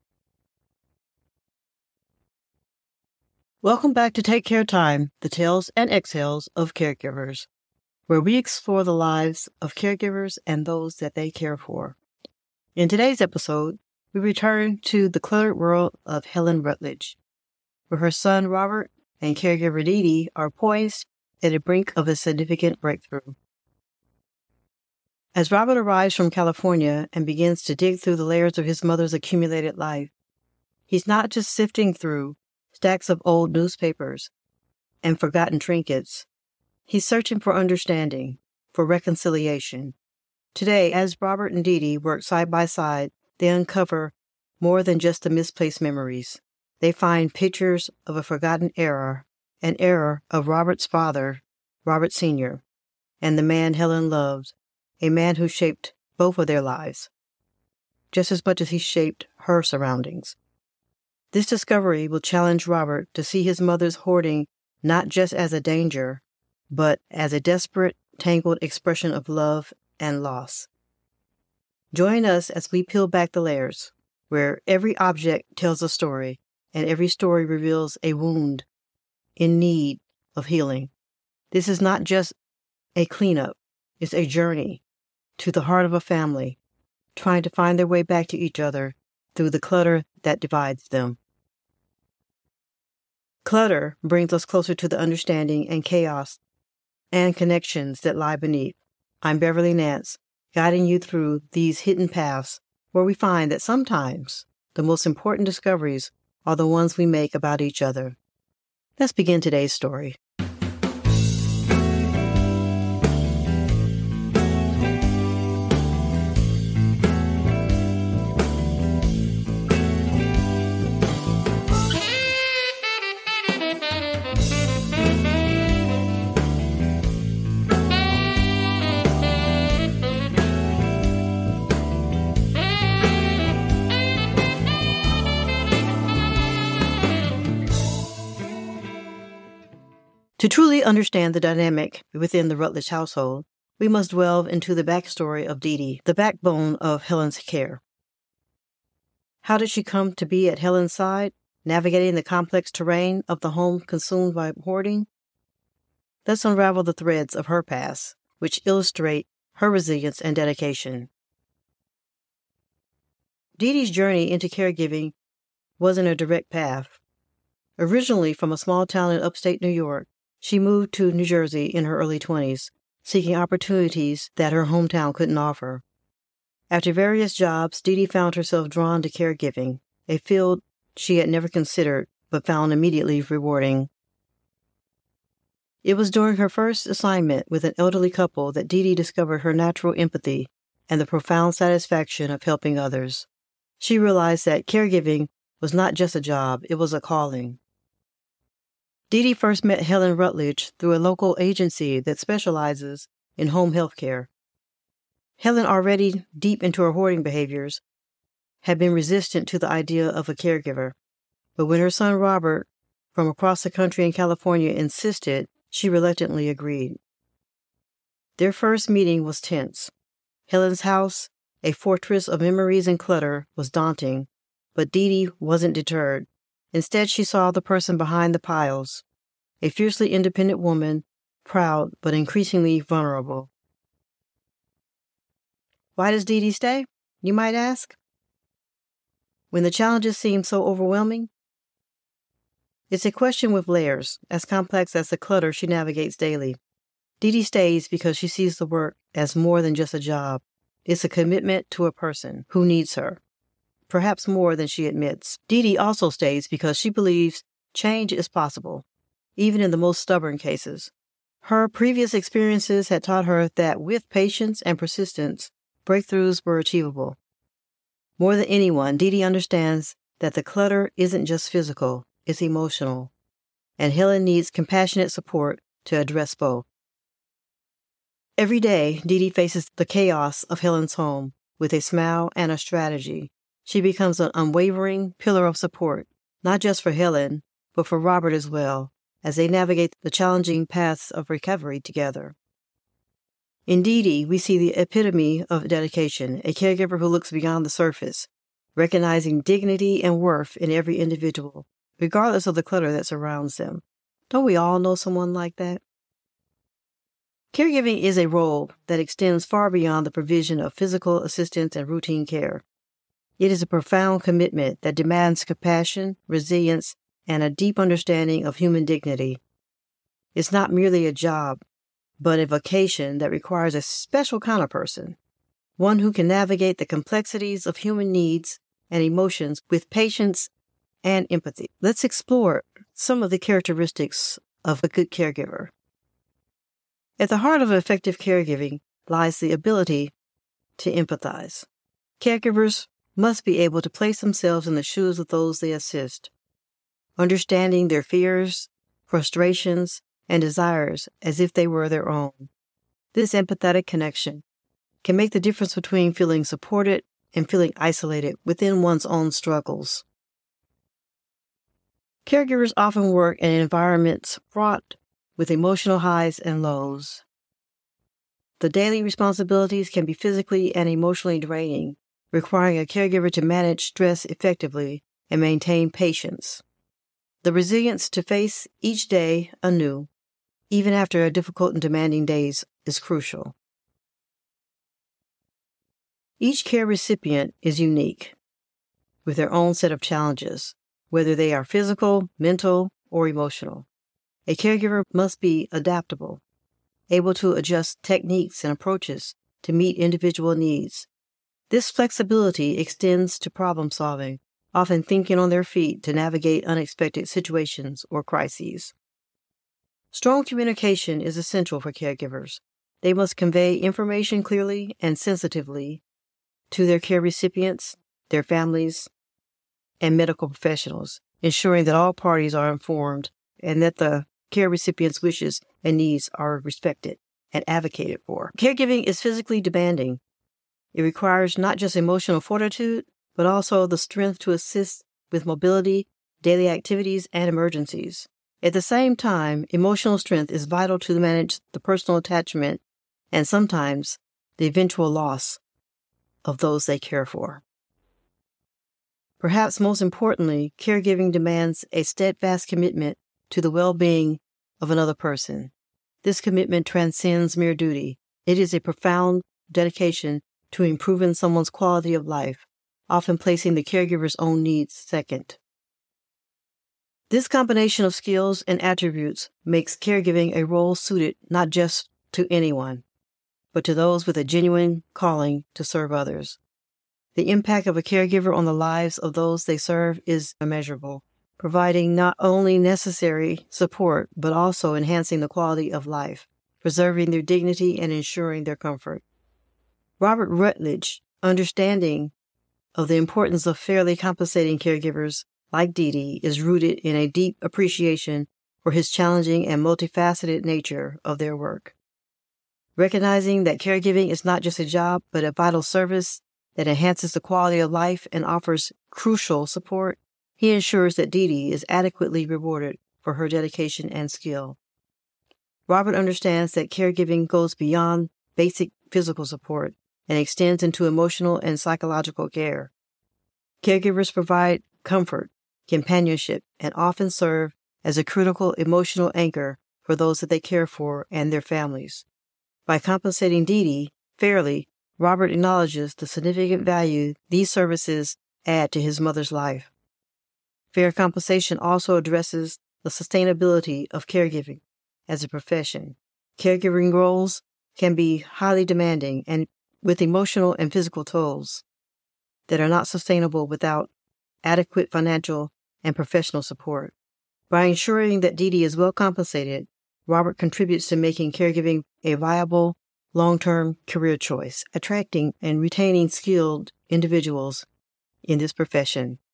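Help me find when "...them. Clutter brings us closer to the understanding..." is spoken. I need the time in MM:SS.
01:30.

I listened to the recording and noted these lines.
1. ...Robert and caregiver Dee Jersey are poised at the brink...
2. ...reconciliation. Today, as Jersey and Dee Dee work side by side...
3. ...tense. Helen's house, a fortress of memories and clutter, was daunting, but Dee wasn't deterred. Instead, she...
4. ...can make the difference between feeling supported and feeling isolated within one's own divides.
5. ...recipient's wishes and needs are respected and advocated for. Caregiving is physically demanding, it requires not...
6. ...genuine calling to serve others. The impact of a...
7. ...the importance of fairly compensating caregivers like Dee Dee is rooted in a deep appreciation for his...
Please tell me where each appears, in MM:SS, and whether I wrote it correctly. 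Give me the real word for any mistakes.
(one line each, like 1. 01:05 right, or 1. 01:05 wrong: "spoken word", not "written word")
1. 00:18 wrong: "Dee", not "Jersey"
2. 00:38 wrong: "Robert", not "Jersey"
3. 03:39 right
4. 05:55 wrong: "struggles", not "divides"
5. 07:04 right
6. 07:54 right
7. 08:13 right.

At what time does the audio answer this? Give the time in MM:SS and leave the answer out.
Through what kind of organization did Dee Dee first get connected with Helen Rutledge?
03:20.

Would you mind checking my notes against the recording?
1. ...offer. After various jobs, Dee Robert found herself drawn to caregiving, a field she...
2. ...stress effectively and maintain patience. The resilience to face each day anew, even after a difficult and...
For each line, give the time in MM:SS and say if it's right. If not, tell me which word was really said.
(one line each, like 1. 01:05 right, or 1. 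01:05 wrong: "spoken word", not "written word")
1. 02:55 wrong: "Dee", not "Robert"
2. 06:13 right.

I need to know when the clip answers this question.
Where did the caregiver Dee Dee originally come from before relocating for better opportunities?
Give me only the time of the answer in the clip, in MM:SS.
02:49.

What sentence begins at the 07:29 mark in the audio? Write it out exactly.
Perhaps most importantly, caregiving demands a steadfast commitment to the well being of another person.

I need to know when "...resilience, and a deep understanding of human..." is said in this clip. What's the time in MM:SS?
05:16.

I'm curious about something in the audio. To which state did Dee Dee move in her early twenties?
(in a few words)
New Jersey.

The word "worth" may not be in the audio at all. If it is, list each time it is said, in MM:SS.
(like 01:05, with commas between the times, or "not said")
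05:00.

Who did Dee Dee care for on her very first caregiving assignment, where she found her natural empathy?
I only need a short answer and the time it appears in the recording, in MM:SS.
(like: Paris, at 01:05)
an elderly couple, at 03:07.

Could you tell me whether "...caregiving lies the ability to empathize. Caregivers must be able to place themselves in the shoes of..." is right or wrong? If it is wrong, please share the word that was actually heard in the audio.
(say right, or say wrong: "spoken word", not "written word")
right.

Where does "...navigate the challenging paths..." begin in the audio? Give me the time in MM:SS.
04:49.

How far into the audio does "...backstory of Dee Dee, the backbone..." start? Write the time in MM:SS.
02:24.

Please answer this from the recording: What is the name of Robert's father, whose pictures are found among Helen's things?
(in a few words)
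Robert Sr.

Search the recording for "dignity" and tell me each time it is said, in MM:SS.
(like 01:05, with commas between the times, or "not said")
04:59, 05:18, 08:07.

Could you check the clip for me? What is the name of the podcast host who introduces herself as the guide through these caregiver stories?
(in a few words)
Beverly Nance.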